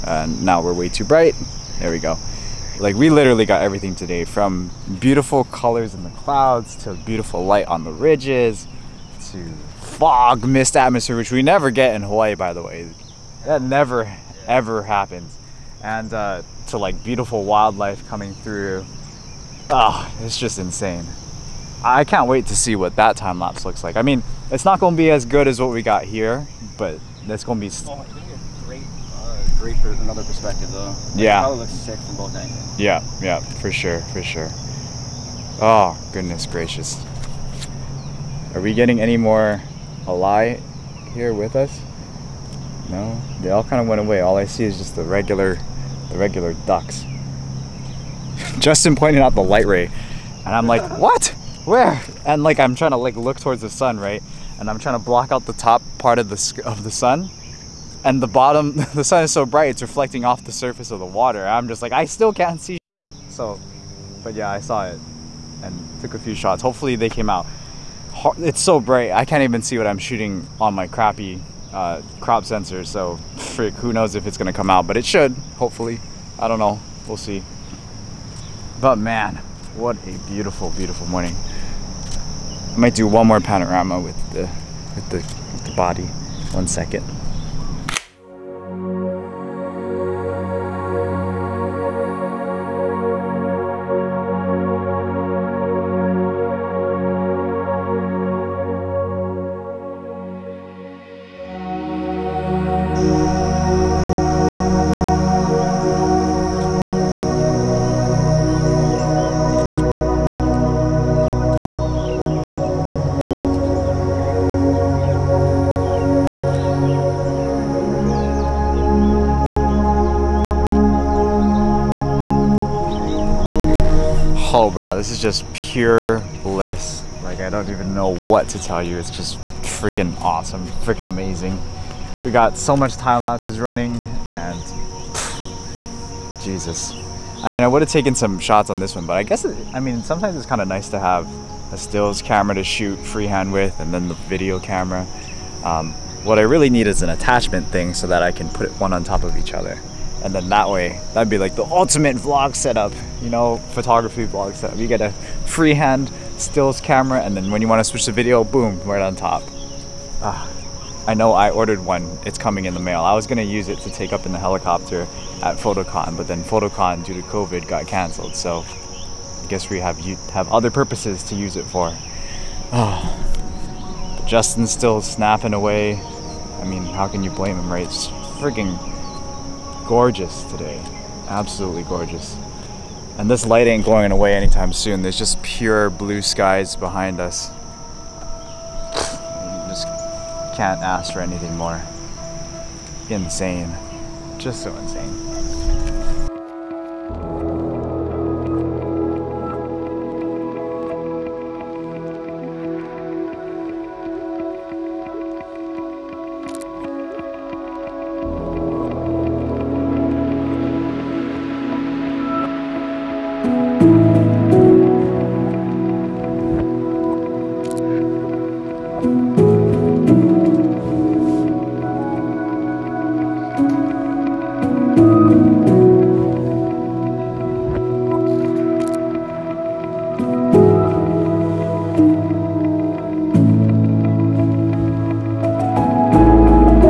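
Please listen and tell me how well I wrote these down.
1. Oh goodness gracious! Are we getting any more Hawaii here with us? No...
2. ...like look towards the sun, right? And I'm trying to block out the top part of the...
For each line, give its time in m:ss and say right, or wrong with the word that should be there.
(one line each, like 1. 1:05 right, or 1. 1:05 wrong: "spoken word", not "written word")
1. 0:35 wrong: "Ally", not "Hawaii"
2. 0:52 right.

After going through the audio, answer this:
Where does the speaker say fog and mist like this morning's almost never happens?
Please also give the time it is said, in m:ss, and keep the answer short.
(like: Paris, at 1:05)
Hawaii, at 0:12.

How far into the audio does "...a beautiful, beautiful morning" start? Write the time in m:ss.
1:20.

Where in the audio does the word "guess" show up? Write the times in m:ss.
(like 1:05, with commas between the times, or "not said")
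2:19, 2:49.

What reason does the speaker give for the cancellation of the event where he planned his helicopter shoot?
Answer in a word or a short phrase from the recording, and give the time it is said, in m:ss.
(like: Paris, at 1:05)
COVID, at 2:47.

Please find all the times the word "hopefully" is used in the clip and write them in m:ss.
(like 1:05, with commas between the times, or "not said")
1:06, 1:15.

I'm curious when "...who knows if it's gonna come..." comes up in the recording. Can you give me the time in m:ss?
1:13.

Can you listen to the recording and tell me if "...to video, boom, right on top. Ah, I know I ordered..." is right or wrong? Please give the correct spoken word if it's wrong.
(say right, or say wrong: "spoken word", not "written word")
right.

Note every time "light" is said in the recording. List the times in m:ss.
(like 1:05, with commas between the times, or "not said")
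0:07, 0:49, 3:03.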